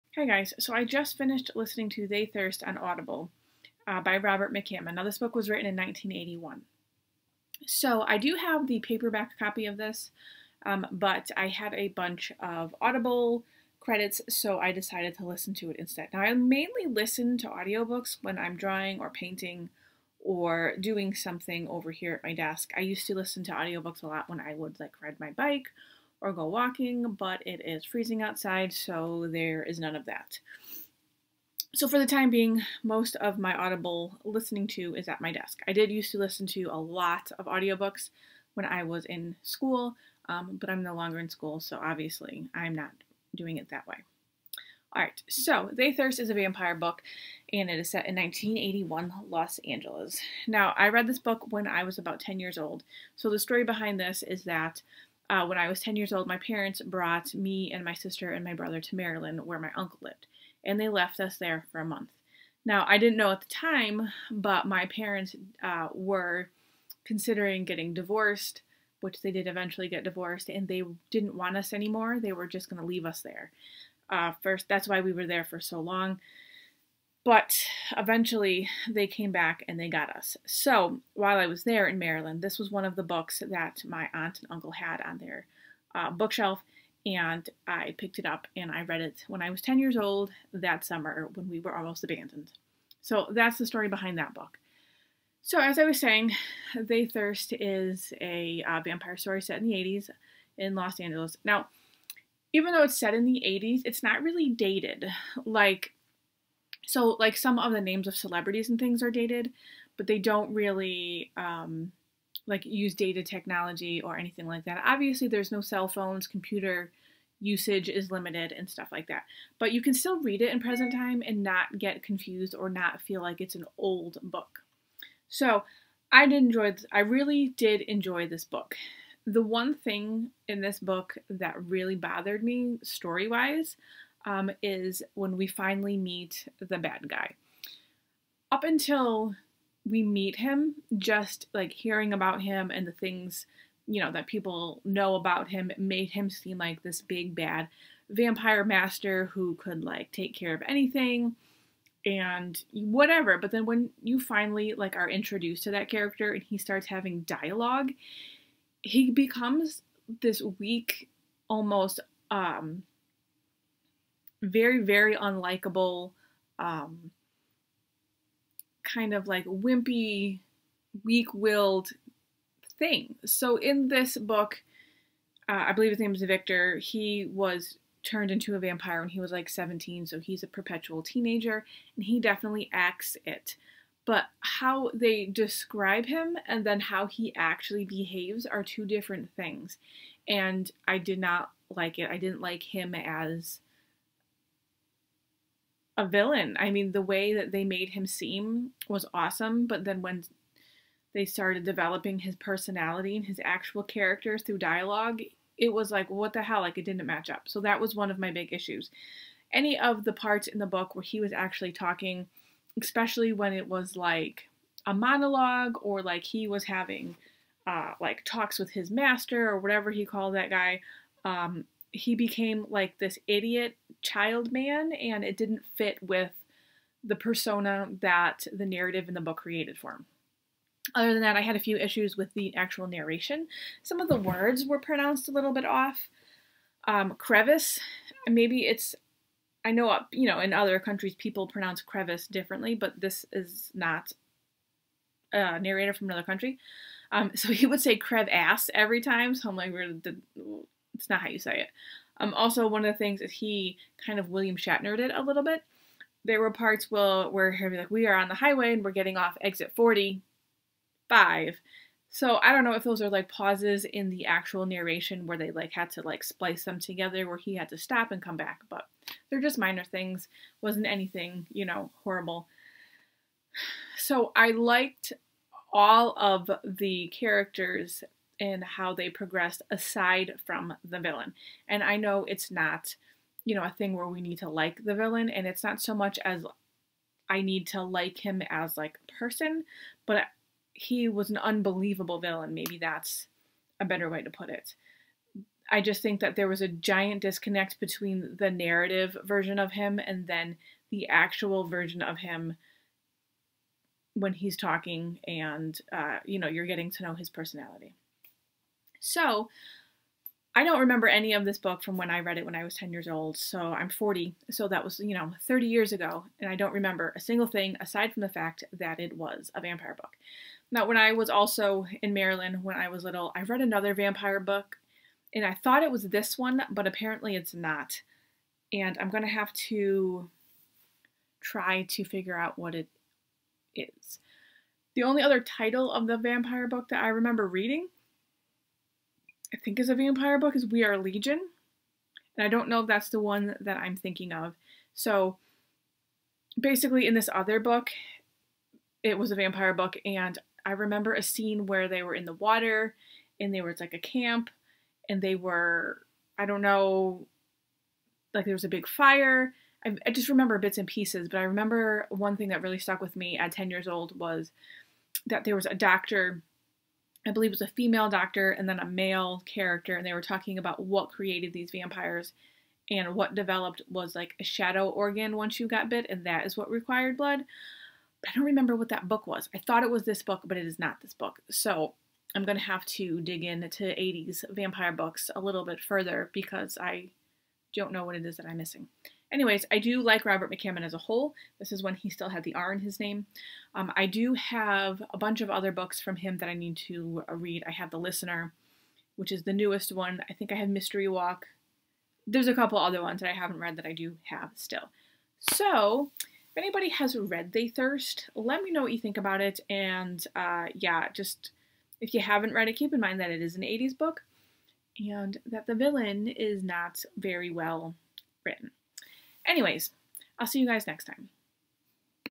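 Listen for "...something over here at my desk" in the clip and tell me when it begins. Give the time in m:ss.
0:21.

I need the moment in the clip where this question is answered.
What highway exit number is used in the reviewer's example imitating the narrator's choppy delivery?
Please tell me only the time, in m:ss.
4:19.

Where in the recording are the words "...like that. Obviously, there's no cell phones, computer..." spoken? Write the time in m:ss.
1:54.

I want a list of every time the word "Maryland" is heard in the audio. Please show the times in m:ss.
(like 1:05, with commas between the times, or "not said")
0:58, 1:21, 5:22.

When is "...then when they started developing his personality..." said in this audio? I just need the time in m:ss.
3:19.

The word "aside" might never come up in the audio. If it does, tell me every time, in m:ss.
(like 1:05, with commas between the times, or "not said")
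4:39, 5:17.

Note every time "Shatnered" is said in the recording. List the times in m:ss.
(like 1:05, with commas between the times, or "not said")
4:14.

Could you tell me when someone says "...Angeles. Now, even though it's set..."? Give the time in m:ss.
1:40.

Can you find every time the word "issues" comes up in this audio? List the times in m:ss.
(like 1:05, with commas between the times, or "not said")
3:28, 3:51.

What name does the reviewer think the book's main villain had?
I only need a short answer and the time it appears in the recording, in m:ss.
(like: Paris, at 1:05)
Victor, at 2:56.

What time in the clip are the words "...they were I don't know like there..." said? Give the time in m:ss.
5:55.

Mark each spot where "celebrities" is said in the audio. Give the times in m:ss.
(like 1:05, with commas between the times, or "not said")
1:48.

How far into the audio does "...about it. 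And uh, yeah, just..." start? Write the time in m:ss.
6:49.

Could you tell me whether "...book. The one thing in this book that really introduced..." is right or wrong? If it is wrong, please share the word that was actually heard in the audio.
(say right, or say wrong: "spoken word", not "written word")
wrong: "bothered", not "introduced".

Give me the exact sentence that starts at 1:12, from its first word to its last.
They were just going to leave us there.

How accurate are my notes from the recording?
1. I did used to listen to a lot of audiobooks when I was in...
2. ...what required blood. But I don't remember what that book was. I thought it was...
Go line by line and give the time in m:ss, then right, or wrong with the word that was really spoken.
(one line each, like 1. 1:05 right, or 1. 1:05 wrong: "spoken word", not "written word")
1. 0:35 right
2. 6:16 right.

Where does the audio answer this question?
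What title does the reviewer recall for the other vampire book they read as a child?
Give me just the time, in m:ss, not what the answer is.
5:40.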